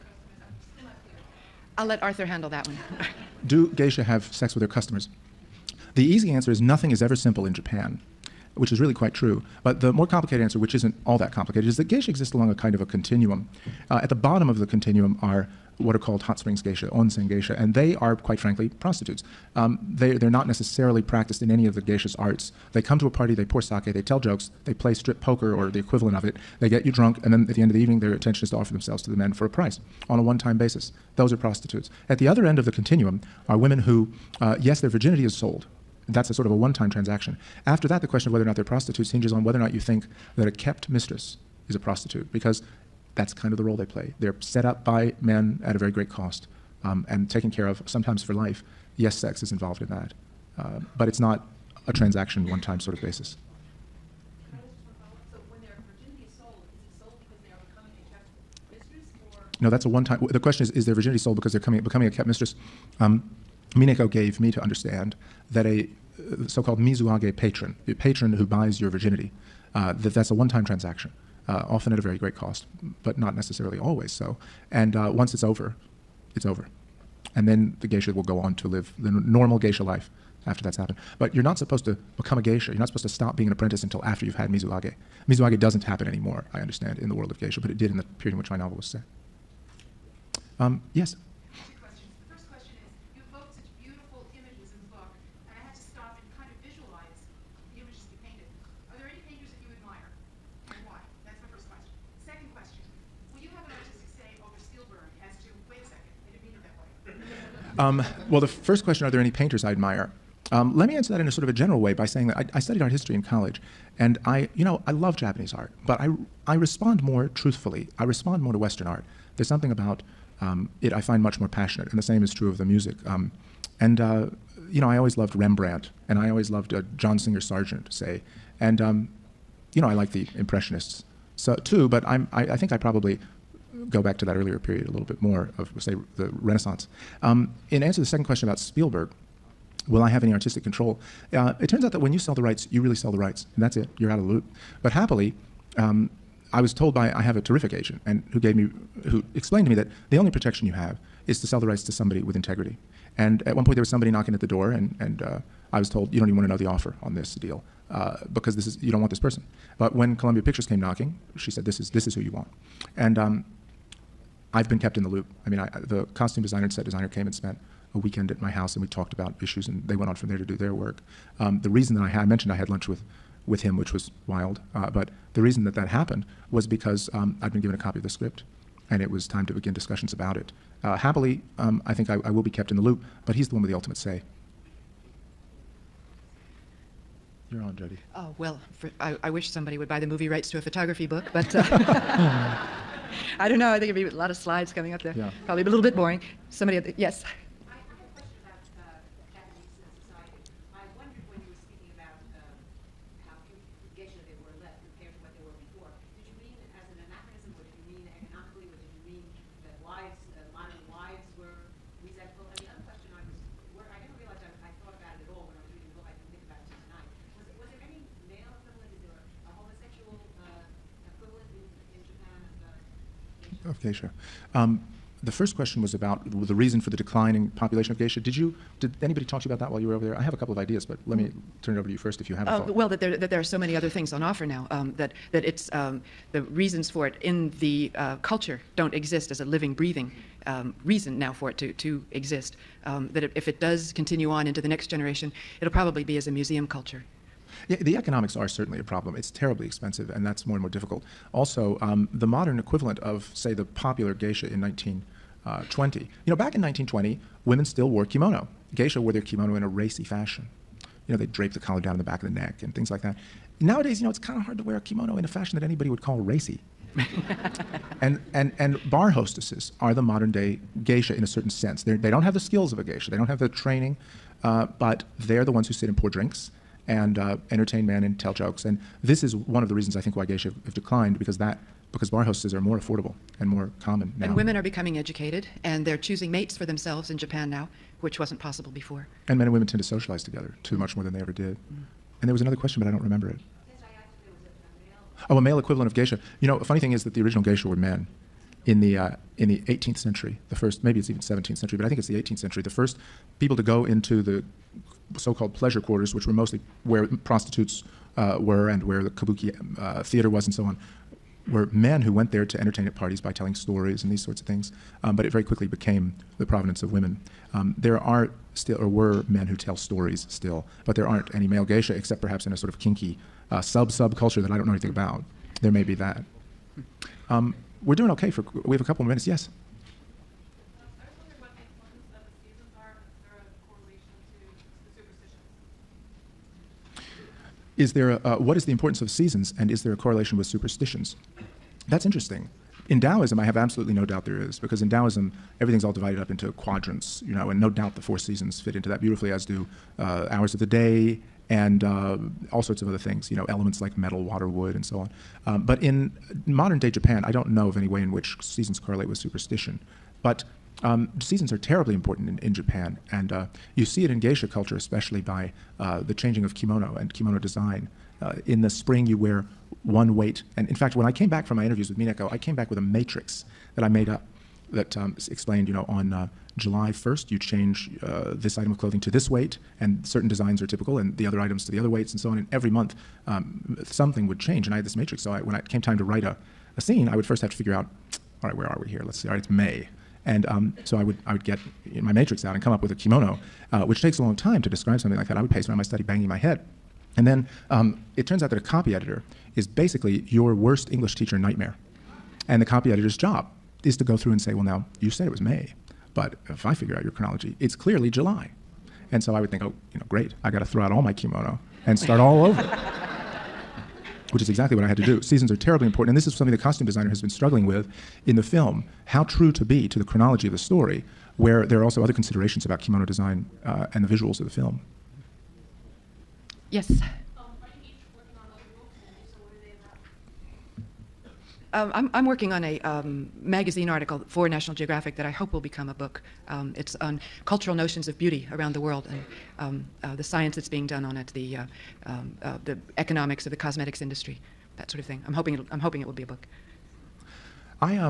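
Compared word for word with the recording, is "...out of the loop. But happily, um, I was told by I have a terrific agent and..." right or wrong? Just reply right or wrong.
right.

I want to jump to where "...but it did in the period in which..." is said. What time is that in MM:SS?
01:27.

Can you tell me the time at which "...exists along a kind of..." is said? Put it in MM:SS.
00:12.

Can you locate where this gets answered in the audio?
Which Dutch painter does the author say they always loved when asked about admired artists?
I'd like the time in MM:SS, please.
02:05.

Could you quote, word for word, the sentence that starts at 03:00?
Uh, happily, um, I think I, I will be kept in the loop, but he's the one with the ultimate say.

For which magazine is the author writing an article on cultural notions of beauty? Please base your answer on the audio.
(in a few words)
National Geographic.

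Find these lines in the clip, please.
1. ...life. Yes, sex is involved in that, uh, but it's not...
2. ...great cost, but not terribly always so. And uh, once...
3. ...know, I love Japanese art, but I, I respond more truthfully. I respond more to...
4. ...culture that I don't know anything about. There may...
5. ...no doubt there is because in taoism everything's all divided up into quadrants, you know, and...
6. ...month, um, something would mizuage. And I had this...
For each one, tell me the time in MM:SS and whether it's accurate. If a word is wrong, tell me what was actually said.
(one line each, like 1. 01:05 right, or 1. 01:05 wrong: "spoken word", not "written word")
1. 00:48 right
2. 01:12 wrong: "necessarily", not "terribly"
3. 01:54 right
4. 05:24 right
5. 05:43 right
6. 06:22 wrong: "change", not "mizuage".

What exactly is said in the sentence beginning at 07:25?
I'm hoping, I'm hoping it will be a book.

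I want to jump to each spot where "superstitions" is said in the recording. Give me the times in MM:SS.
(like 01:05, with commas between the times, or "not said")
05:40, 05:59.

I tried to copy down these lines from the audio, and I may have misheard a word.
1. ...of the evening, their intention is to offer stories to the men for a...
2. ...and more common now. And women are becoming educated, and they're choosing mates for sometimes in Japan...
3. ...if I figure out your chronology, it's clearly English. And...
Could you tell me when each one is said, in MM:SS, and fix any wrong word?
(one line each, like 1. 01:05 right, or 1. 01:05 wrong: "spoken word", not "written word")
1. 00:27 wrong: "themselves", not "stories"
2. 04:43 wrong: "themselves", not "sometimes"
3. 06:46 wrong: "July", not "English".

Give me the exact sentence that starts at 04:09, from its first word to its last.
It's terribly expensive, and that's more and more difficult.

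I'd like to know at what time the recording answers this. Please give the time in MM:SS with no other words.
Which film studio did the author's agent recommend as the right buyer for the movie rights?
02:40.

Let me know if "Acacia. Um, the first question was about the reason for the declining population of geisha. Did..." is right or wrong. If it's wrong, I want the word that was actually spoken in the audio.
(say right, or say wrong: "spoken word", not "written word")
right.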